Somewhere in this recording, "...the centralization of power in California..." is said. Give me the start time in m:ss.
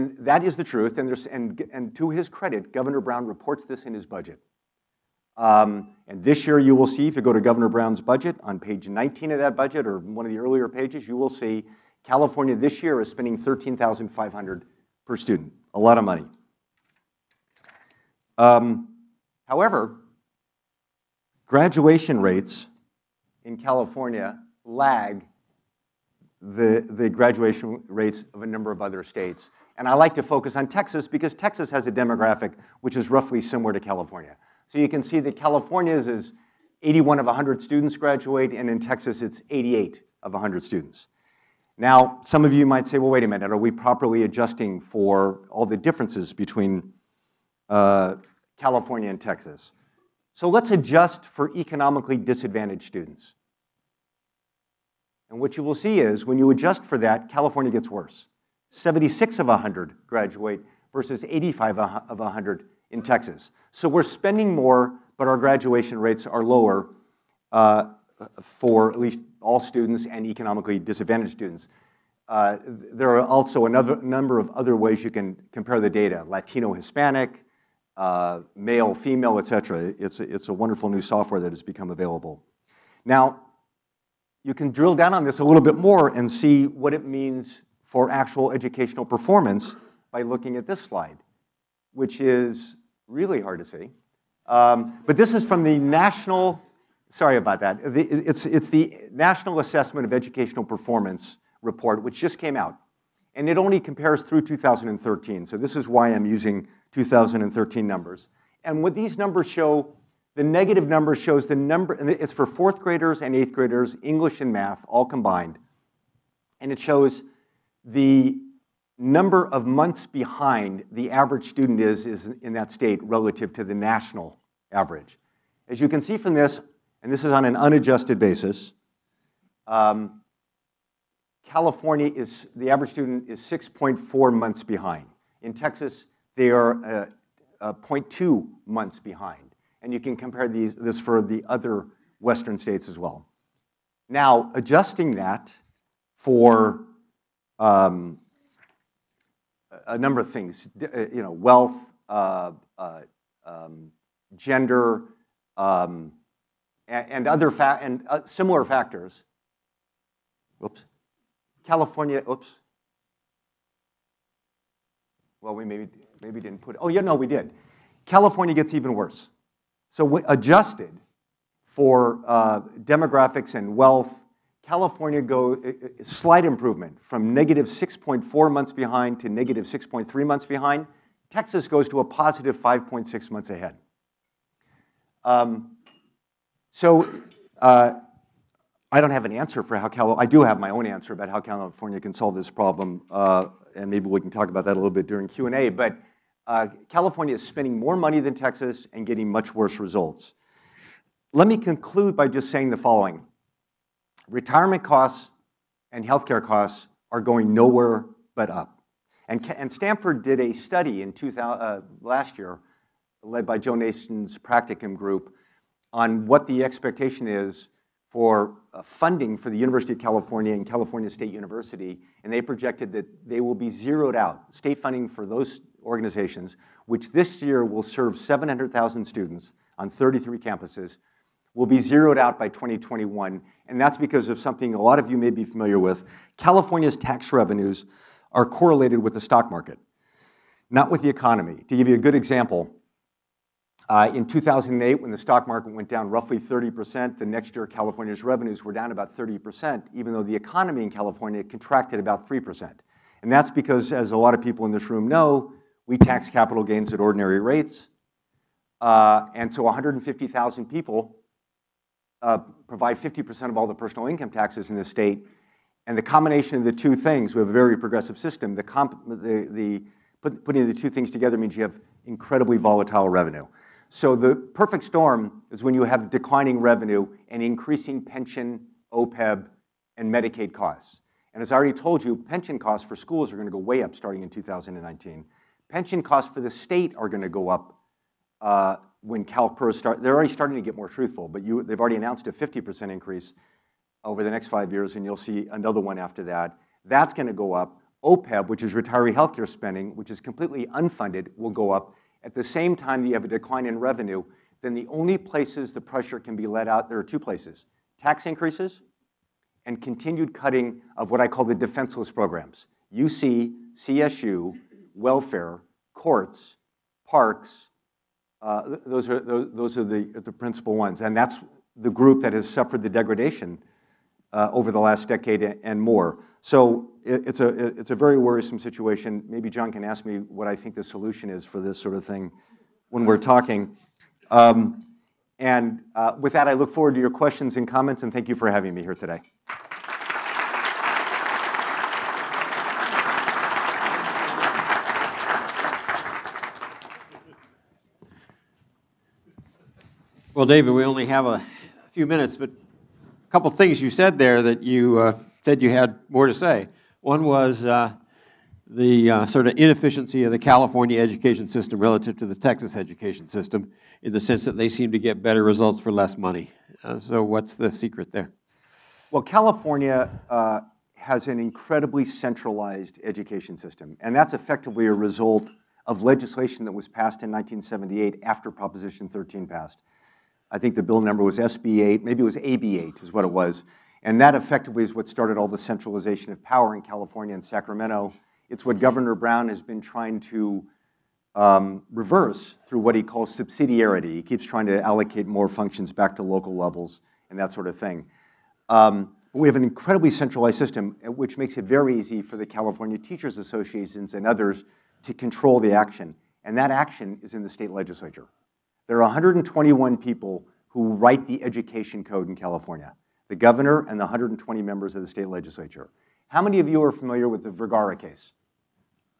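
6:25.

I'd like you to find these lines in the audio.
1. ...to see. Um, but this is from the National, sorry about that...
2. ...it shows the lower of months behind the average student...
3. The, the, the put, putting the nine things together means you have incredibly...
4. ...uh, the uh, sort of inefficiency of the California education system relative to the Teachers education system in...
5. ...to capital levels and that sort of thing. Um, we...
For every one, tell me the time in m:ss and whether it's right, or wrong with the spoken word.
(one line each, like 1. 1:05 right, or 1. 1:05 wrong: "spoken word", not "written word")
1. 1:33 right
2. 1:56 wrong: "number", not "lower"
3. 4:28 wrong: "two", not "nine"
4. 5:57 wrong: "Texas", not "Teachers"
5. 6:36 wrong: "local", not "capital".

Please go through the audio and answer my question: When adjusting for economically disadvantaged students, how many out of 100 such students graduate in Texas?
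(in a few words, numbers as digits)
85.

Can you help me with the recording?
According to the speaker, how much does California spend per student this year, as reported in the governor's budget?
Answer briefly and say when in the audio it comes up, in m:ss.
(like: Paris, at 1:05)
13500, at 0:13.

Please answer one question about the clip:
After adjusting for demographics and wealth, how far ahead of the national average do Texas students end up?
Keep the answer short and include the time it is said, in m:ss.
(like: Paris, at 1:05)
5.6 months, at 3:02.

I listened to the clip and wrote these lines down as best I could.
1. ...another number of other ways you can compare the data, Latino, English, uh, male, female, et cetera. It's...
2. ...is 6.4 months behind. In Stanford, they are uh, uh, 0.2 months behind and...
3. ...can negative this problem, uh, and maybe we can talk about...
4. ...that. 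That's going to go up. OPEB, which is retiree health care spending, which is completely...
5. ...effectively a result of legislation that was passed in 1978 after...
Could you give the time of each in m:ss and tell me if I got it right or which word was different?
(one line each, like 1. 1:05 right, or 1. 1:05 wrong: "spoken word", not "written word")
1. 1:13 wrong: "Hispanic", not "English"
2. 2:13 wrong: "Texas", not "Stanford"
3. 3:11 wrong: "solve", not "negative"
4. 4:56 right
5. 6:14 right.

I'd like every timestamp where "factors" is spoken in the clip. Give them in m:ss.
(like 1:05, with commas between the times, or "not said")
2:38.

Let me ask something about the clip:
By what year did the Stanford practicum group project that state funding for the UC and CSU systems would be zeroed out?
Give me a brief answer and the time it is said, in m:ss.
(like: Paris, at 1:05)
2021, at 3:52.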